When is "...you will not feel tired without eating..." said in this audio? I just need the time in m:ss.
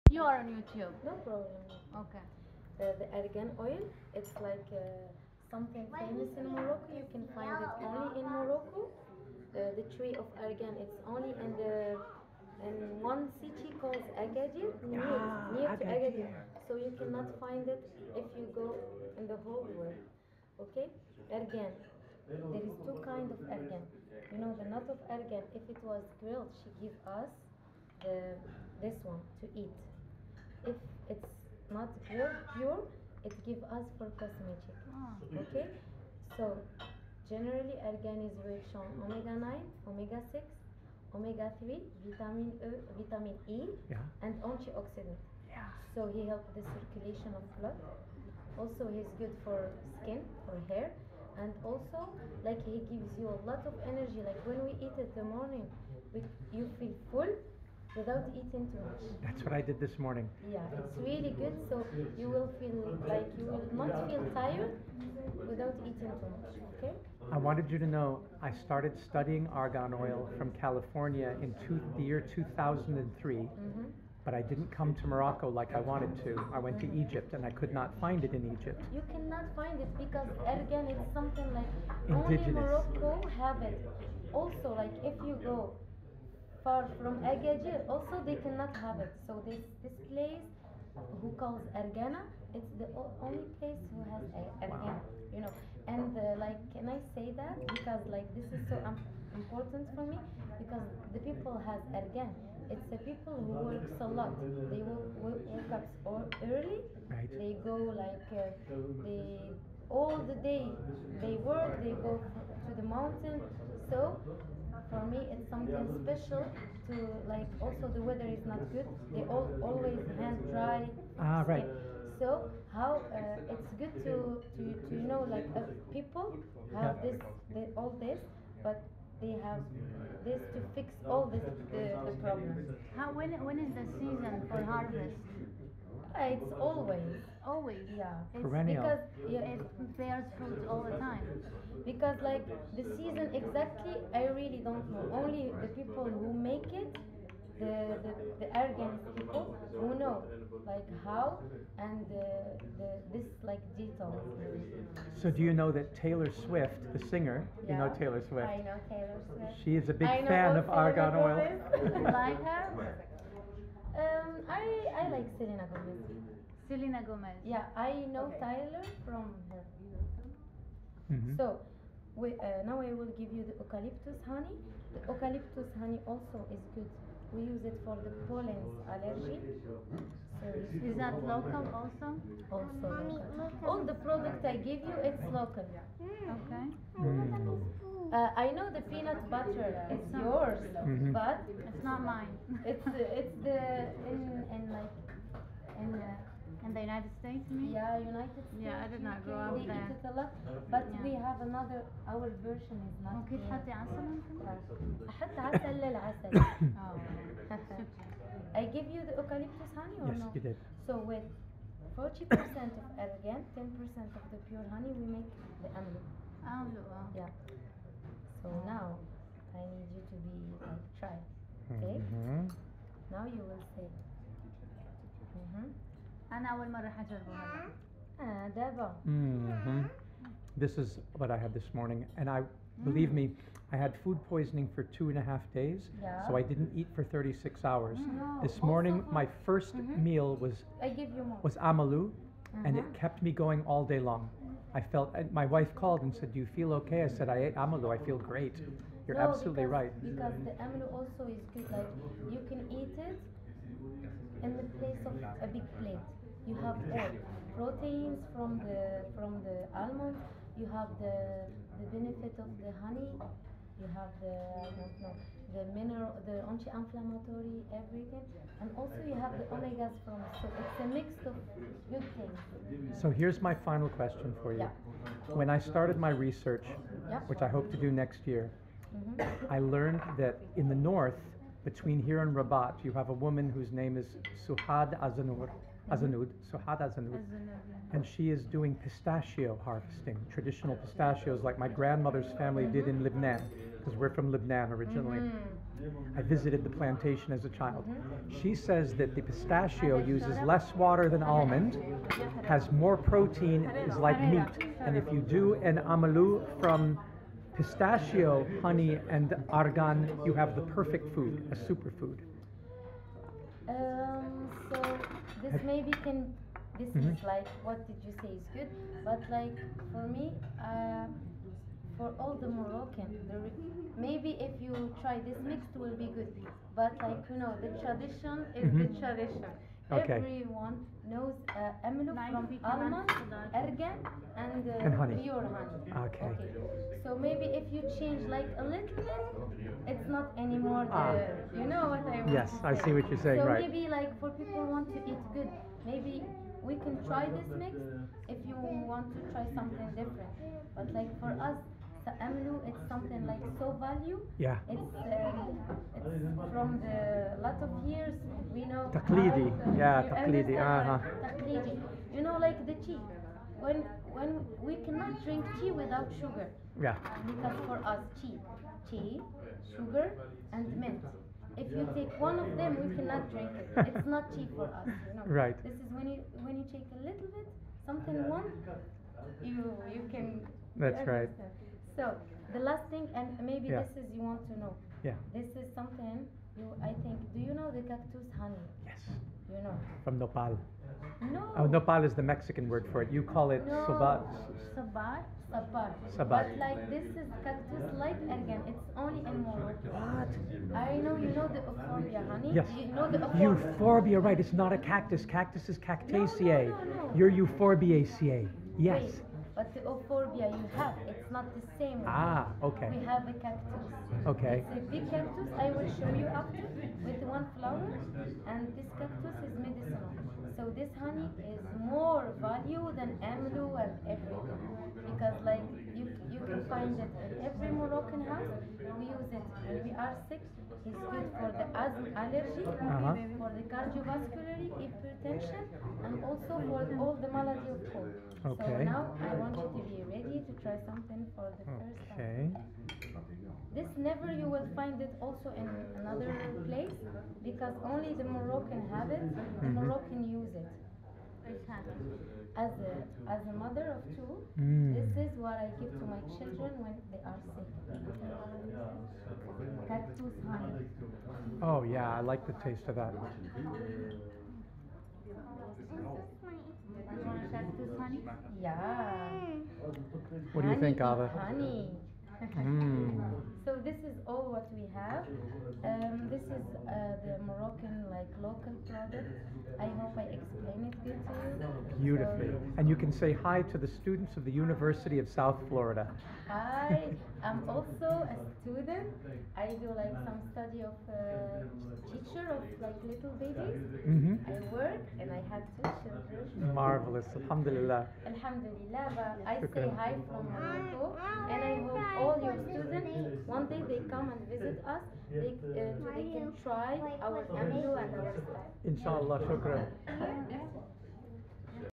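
1:03.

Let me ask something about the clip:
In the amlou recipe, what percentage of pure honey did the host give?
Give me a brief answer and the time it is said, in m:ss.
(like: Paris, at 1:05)
10%, at 3:33.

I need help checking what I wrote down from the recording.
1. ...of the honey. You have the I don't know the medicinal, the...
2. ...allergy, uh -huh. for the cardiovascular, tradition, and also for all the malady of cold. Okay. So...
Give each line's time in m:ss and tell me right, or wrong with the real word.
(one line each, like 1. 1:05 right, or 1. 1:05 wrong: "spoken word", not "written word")
1. 4:22 wrong: "mineral", not "medicinal"
2. 7:12 wrong: "hypertension", not "tradition".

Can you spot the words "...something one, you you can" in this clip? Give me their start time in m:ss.
6:17.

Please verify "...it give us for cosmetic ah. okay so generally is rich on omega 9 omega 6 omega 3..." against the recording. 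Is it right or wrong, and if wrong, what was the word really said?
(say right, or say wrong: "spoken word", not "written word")
right.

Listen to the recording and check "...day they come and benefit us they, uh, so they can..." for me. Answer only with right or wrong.
wrong.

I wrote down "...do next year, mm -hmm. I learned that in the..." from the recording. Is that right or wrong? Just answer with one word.
right.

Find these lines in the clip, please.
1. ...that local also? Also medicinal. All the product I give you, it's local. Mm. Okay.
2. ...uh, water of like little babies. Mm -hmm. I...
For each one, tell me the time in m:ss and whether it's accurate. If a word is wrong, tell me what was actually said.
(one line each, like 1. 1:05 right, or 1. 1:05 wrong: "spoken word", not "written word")
1. 3:00 wrong: "local", not "medicinal"
2. 8:11 wrong: "teacher", not "water".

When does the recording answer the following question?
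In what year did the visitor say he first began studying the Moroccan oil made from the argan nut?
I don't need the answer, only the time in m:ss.
1:11.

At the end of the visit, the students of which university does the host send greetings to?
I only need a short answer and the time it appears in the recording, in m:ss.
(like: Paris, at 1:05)
University of South Florida, at 8:04.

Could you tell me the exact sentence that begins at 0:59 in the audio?
That's what I did this morning.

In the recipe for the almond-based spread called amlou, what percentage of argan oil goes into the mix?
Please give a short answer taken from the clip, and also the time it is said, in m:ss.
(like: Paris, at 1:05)
40%, at 3:31.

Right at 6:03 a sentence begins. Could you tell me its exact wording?
When when we cannot drink tea without sugar.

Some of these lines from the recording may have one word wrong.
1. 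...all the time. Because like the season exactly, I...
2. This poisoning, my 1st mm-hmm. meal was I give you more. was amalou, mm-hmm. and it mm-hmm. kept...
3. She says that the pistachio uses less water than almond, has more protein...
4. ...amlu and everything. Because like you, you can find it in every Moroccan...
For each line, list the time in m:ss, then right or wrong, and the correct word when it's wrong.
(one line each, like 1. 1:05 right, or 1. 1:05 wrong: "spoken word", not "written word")
1. 2:20 right
2. 3:58 wrong: "morning", not "poisoning"
3. 4:58 right
4. 7:03 right.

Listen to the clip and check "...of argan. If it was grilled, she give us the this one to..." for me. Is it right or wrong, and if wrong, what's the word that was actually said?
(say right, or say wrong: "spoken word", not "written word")
right.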